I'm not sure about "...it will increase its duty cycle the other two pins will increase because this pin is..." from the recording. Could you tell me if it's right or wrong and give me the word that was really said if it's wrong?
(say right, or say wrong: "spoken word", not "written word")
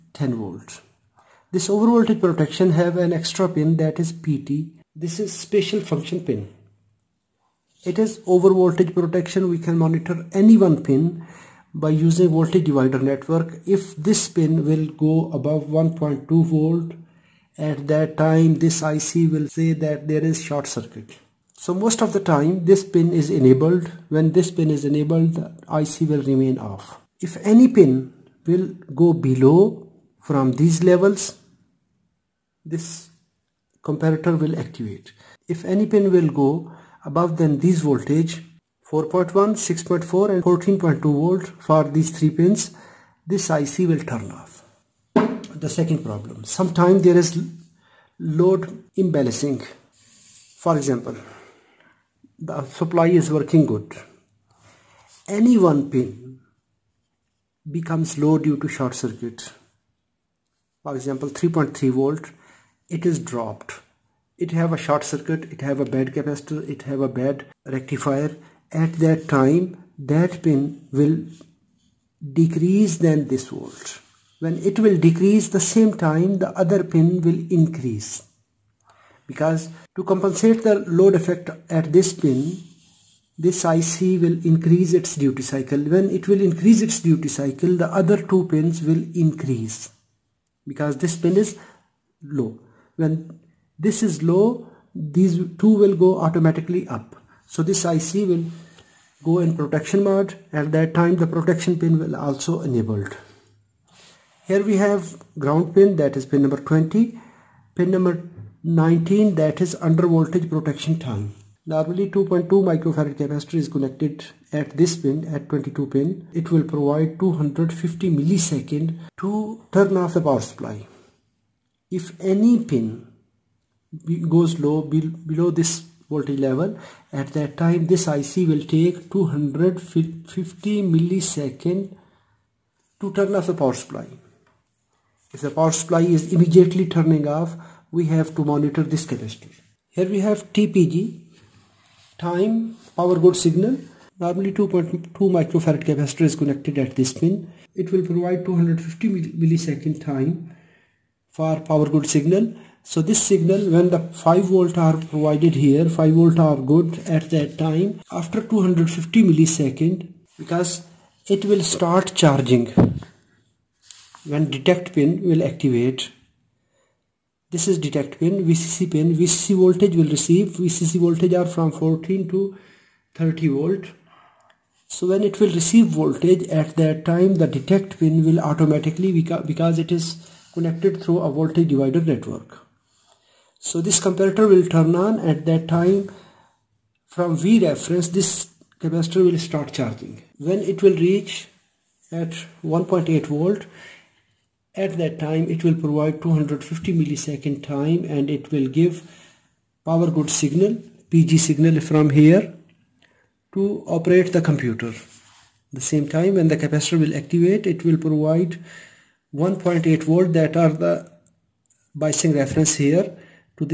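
right.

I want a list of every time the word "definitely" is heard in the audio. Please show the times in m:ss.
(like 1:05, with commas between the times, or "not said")
not said.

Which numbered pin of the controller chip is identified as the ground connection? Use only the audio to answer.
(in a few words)
20.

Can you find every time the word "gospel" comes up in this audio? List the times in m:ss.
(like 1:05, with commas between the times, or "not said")
not said.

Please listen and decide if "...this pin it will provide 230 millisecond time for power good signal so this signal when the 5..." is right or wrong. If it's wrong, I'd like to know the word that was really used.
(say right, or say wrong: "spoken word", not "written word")
wrong: "250", not "230".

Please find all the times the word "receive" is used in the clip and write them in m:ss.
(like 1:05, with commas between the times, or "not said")
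2:50, 2:55.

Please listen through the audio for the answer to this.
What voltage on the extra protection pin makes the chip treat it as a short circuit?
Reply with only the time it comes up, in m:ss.
0:15.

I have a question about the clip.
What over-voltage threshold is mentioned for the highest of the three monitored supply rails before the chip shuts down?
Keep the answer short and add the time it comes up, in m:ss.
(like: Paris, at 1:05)
14.2 volts, at 0:40.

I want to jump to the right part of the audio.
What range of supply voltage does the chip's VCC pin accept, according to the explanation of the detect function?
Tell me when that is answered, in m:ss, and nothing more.
2:51.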